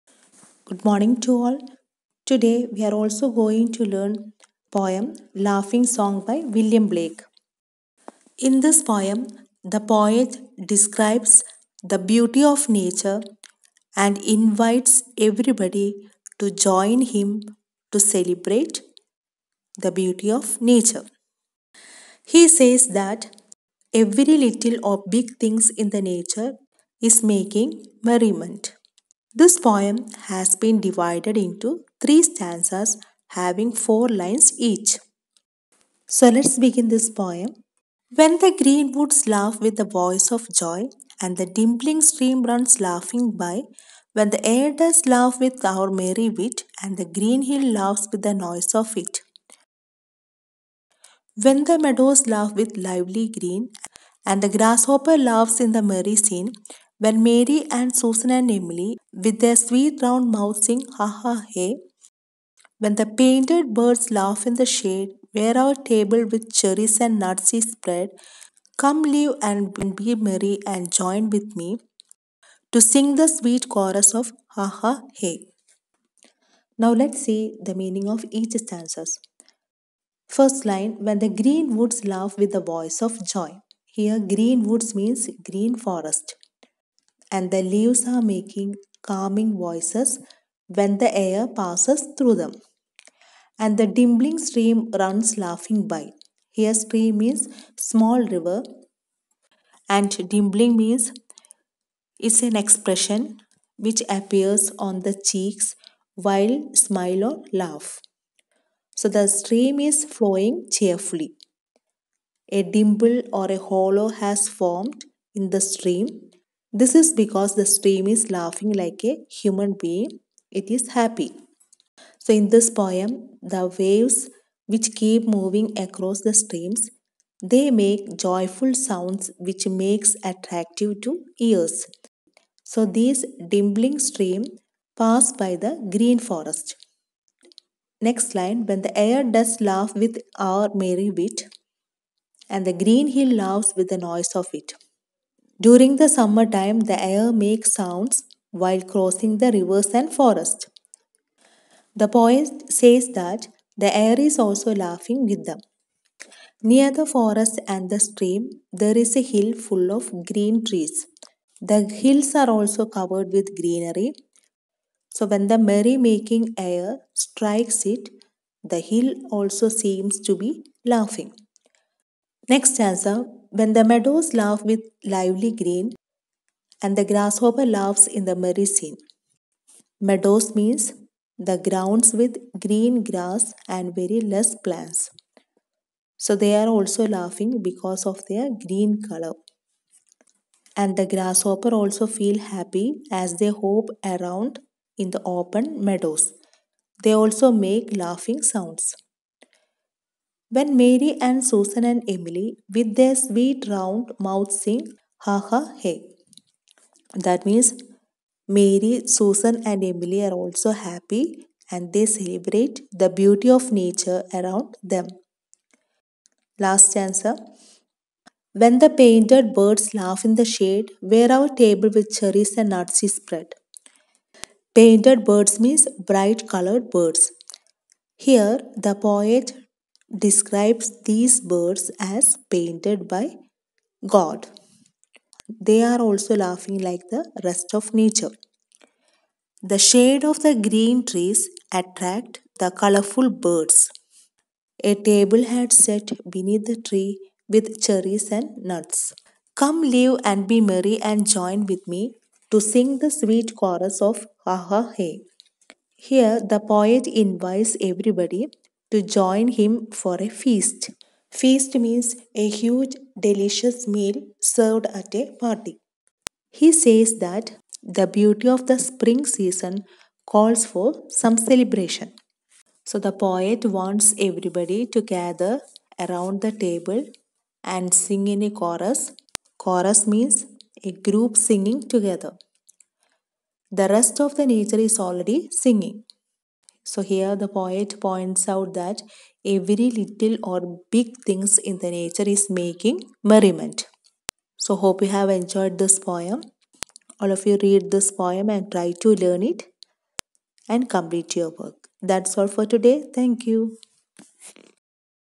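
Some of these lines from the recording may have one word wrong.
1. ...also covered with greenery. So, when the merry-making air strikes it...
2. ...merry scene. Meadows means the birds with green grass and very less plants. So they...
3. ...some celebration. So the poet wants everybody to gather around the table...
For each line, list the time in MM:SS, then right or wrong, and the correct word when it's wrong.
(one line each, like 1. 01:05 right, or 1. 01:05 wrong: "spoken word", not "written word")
1. 02:42 right
2. 02:58 wrong: "grounds", not "birds"
3. 04:31 right.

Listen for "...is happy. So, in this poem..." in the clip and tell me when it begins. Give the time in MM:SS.
02:00.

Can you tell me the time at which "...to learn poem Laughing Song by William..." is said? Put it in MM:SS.
00:03.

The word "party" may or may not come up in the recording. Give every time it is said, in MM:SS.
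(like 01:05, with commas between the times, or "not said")
04:25.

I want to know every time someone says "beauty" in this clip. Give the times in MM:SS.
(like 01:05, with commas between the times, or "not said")
00:12, 00:19, 03:33, 04:28.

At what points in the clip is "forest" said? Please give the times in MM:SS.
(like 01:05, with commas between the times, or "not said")
01:25, 02:16, 02:30, 02:37.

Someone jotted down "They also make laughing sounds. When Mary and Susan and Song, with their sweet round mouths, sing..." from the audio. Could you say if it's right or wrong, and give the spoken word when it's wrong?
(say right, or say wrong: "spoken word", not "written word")
wrong: "Emily", not "Song".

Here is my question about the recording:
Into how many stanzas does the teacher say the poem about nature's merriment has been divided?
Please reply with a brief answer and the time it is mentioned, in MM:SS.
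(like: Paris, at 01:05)
3, at 00:32.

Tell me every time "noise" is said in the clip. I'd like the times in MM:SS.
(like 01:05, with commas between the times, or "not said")
00:48, 02:23.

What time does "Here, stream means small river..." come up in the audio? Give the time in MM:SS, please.
01:36.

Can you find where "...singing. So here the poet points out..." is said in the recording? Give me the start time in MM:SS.
04:45.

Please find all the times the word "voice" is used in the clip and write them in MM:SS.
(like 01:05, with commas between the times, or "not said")
00:39, 01:22, 01:29.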